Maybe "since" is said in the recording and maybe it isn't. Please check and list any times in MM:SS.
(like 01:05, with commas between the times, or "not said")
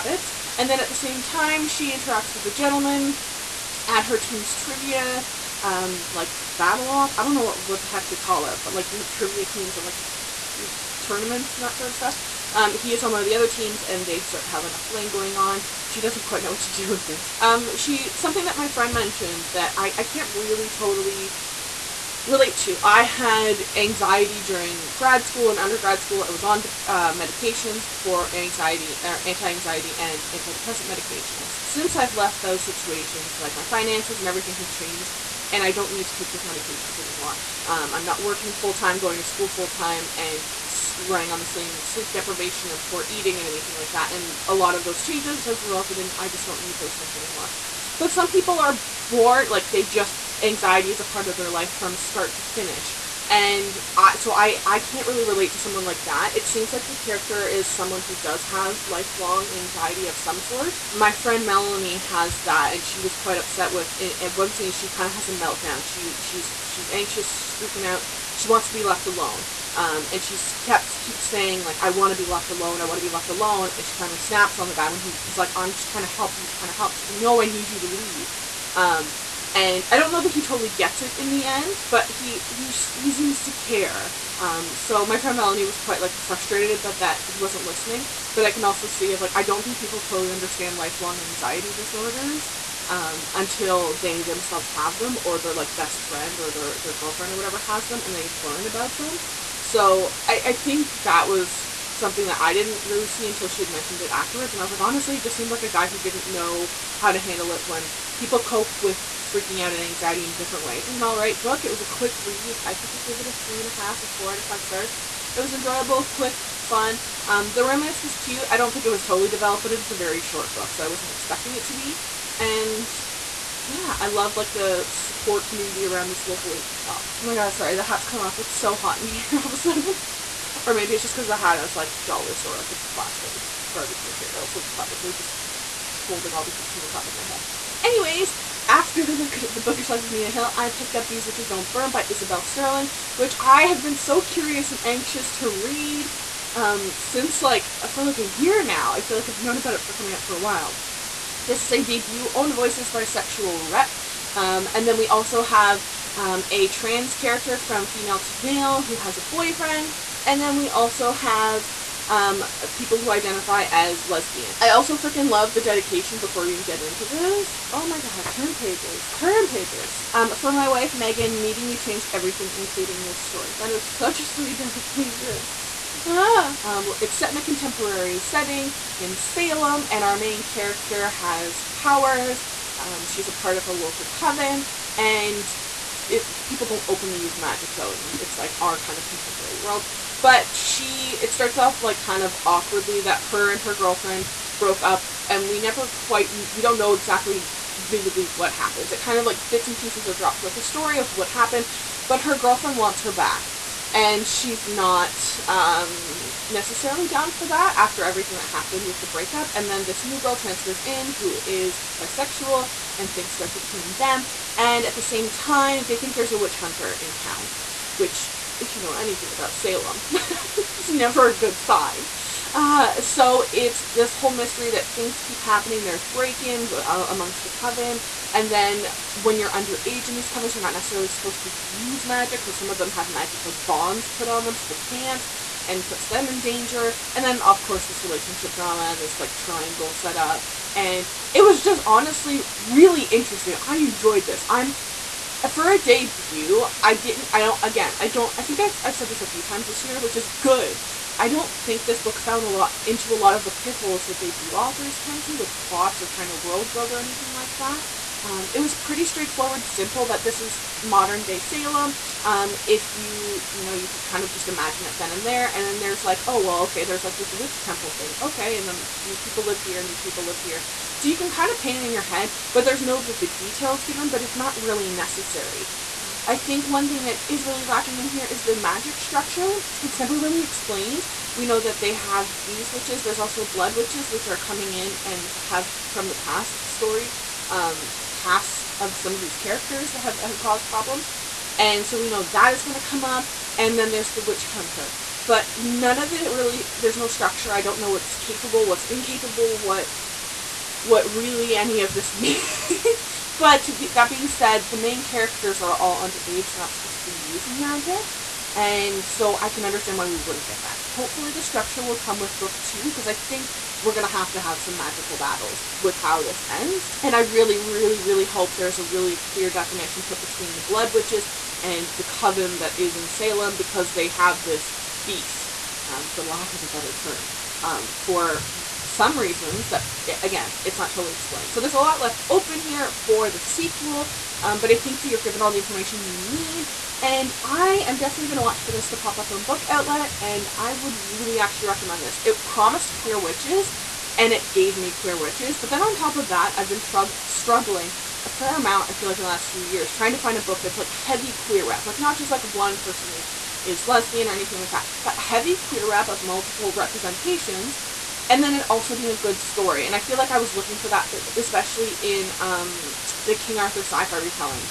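00:31, 02:26.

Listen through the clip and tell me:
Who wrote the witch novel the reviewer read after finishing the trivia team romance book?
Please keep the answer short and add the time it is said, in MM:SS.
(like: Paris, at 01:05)
Isabel Sterling, at 02:22.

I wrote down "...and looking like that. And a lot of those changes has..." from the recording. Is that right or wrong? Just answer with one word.
wrong.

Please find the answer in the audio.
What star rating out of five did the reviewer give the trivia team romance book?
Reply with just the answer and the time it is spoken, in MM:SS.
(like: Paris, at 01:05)
3.5 or 4, at 01:53.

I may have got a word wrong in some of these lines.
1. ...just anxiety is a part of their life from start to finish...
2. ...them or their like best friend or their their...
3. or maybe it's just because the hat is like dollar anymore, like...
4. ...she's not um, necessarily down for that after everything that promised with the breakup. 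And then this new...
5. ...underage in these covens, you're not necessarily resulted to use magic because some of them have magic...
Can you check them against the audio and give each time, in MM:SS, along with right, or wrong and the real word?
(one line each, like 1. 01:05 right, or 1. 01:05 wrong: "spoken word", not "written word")
1. 00:49 right
2. 01:34 right
3. 02:10 wrong: "store", not "anymore"
4. 03:24 wrong: "happened", not "promised"
5. 03:49 wrong: "supposed", not "resulted".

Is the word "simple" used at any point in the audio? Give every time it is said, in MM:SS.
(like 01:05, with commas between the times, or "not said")
04:19.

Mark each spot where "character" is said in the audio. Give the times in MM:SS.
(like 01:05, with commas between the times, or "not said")
00:56, 02:37, 03:00, 04:49, 05:05.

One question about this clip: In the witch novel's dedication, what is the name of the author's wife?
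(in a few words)
Megan.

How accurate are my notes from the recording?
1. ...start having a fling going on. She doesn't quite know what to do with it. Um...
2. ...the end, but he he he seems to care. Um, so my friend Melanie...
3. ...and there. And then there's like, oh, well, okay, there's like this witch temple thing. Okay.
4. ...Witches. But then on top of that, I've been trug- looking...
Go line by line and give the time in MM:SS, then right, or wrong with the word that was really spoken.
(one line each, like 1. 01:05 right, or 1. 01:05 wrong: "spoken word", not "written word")
1. 00:14 right
2. 01:21 right
3. 04:25 right
4. 05:45 wrong: "struggling", not "looking".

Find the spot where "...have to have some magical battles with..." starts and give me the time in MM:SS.
05:14.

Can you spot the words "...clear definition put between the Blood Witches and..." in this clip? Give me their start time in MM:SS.
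05:19.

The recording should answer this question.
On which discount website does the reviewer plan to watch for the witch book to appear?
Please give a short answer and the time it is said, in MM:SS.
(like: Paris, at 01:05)
Book Outlet, at 05:39.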